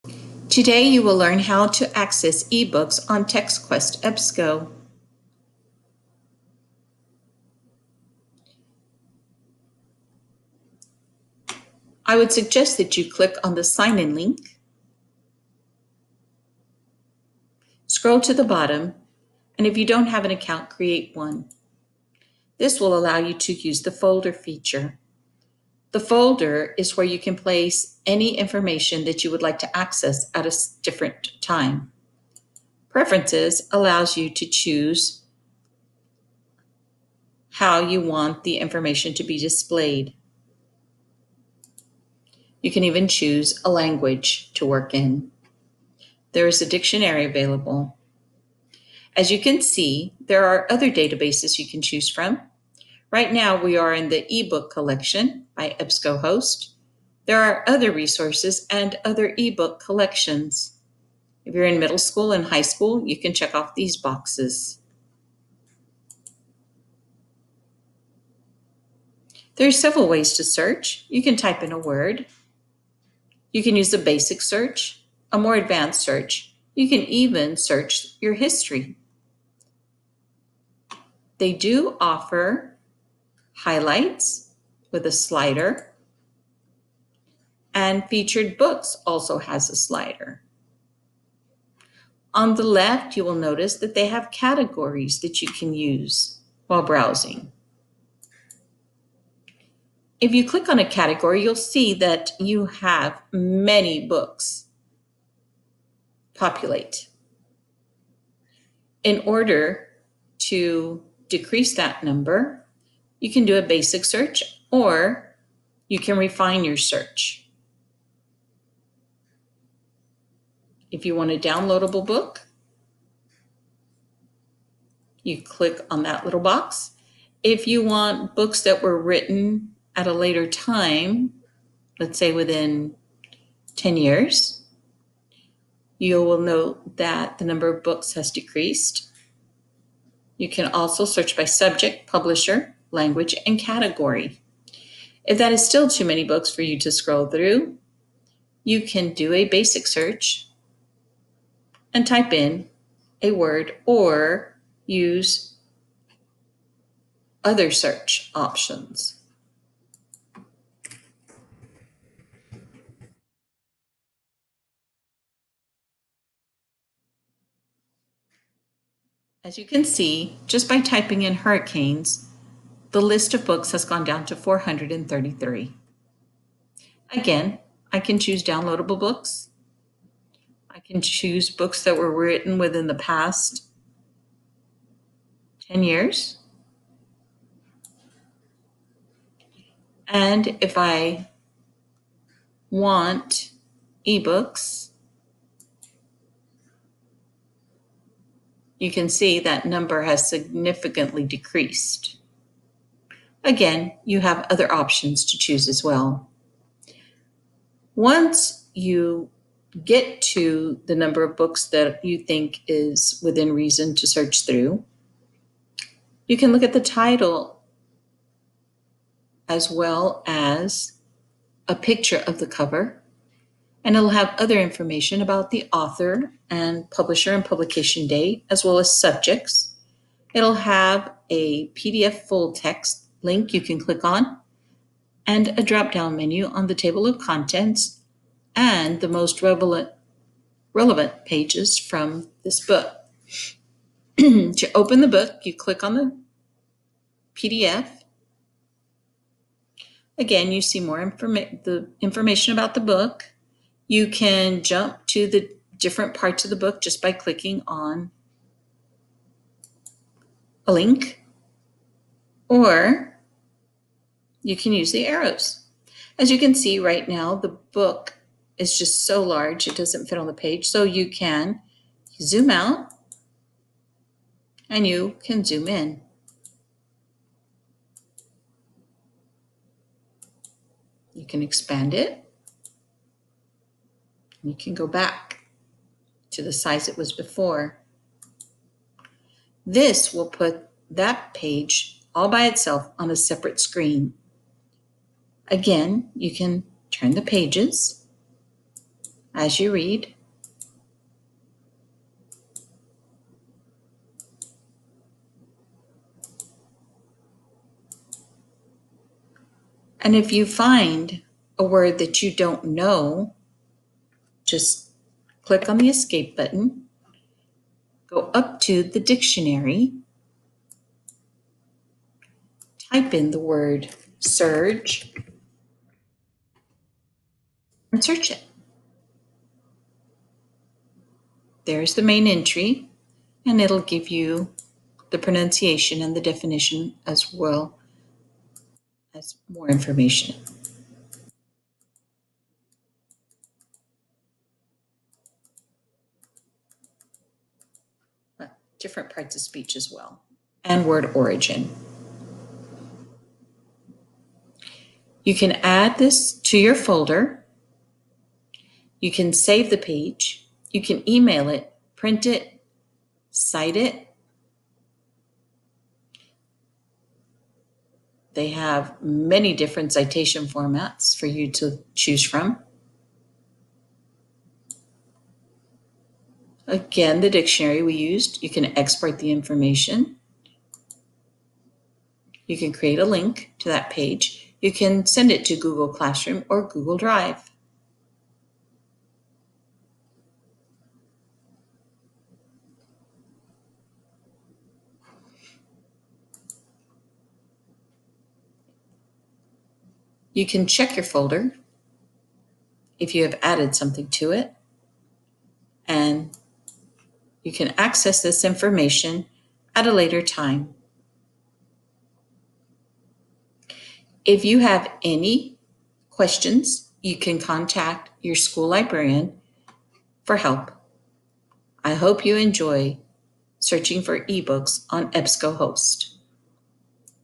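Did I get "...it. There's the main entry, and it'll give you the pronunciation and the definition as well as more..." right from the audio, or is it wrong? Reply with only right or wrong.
right.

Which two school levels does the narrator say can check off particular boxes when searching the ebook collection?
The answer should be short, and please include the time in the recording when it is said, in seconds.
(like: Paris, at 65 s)
middle school and high school, at 61 s.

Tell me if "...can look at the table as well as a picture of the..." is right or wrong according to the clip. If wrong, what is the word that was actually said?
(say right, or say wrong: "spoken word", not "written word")
wrong: "title", not "table".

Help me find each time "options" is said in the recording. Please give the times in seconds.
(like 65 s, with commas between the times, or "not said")
158 s, 204 s.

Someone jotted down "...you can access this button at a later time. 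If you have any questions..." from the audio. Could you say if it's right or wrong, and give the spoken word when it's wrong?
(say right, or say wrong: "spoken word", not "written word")
wrong: "information", not "button".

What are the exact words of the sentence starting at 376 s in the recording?
Again, the dictionary we used, you can export the information.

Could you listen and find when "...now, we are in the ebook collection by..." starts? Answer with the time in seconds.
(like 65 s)
53 s.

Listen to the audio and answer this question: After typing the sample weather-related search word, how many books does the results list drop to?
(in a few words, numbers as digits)
433.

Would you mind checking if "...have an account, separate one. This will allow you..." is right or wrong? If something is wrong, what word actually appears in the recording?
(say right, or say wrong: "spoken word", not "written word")
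wrong: "create", not "separate".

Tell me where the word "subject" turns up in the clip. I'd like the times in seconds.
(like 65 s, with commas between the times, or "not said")
141 s, 228 s.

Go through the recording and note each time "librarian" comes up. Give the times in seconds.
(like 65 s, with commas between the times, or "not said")
418 s.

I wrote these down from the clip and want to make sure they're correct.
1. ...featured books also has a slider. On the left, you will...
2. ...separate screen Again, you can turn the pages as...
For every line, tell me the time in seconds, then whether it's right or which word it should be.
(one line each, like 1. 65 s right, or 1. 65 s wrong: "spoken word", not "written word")
1. 88 s right
2. 293 s right.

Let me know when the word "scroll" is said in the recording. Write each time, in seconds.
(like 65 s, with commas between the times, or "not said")
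17 s, 146 s.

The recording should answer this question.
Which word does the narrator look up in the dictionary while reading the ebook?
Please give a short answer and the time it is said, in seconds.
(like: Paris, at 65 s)
surge, at 324 s.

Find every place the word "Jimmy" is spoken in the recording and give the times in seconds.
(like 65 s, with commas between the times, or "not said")
not said.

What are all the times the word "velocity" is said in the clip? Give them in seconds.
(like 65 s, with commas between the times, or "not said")
not said.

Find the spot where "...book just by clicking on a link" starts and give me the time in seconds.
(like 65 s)
256 s.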